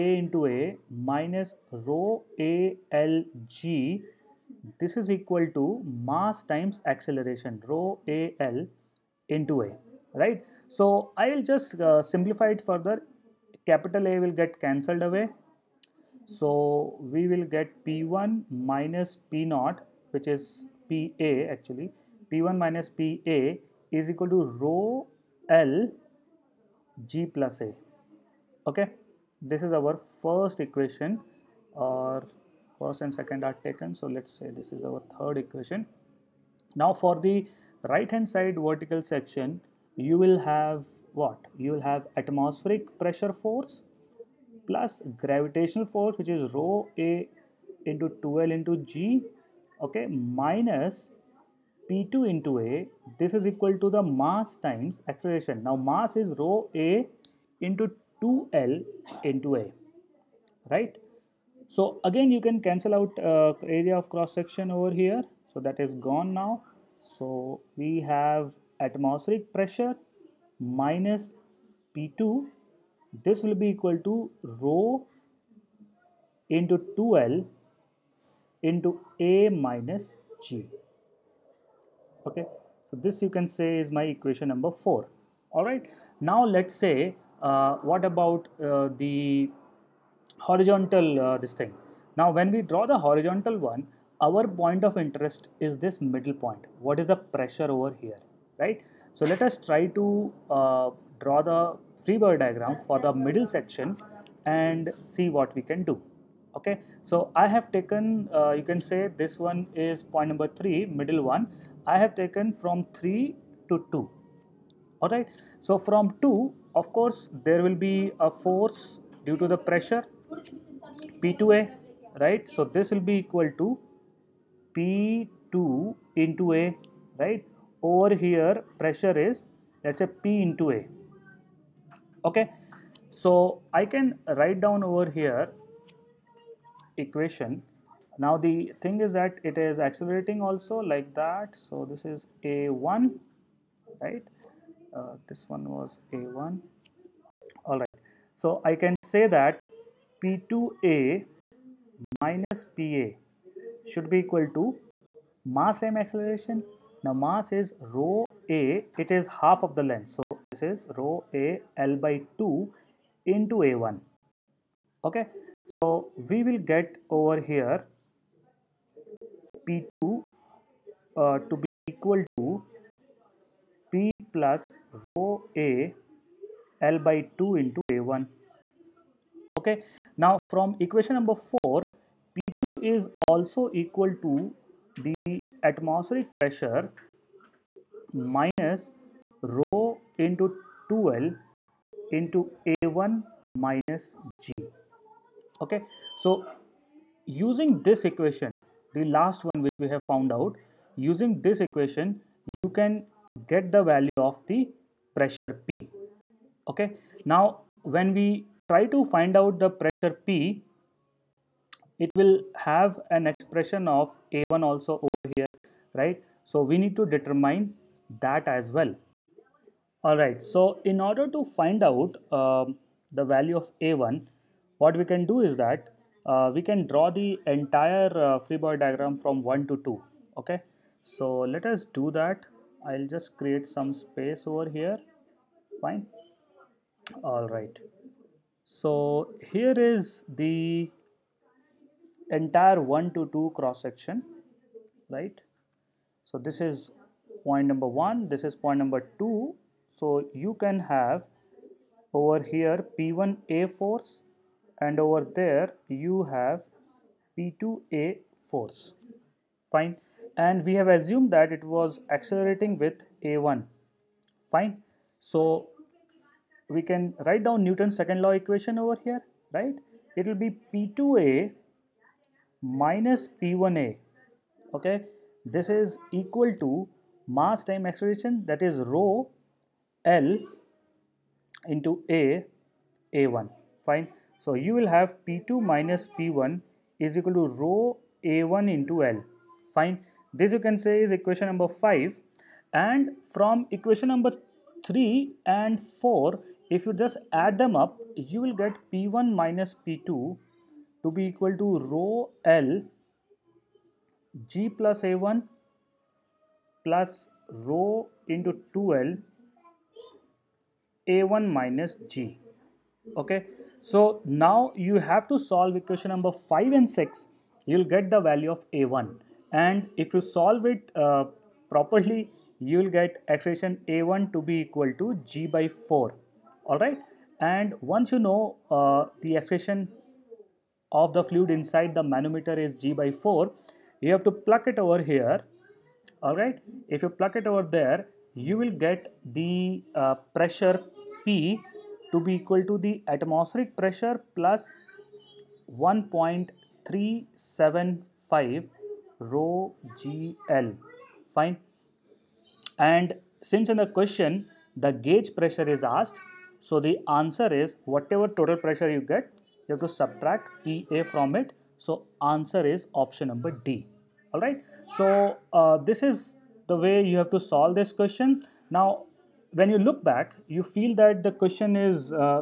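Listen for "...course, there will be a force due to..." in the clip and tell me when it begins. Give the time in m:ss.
1:56.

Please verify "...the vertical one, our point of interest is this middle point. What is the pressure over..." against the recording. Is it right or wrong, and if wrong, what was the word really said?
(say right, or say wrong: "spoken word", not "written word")
wrong: "horizontal", not "vertical".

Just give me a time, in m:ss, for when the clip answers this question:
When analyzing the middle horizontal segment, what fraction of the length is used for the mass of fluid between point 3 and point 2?
2:39.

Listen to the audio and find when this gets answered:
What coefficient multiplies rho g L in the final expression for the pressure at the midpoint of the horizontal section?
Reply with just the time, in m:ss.
5:45.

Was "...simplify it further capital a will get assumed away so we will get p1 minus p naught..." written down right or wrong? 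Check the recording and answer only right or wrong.
wrong.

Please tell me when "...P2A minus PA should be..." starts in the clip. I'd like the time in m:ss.
2:30.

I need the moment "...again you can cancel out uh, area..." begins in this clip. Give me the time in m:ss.
1:02.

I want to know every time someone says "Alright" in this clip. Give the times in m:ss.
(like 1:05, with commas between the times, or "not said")
1:25, 1:55.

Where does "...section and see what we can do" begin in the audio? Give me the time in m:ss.
1:43.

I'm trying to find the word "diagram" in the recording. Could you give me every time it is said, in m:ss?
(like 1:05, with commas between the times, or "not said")
1:42, 3:48.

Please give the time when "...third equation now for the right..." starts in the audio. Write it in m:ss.
0:35.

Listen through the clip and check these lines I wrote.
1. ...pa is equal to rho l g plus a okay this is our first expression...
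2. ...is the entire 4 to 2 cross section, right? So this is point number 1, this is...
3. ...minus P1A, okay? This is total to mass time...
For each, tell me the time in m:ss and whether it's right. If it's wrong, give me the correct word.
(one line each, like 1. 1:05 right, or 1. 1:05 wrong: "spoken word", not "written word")
1. 0:22 wrong: "equation", not "expression"
2. 3:59 wrong: "1", not "4"
3. 4:32 wrong: "equal", not "total".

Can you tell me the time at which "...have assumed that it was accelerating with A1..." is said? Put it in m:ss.
4:20.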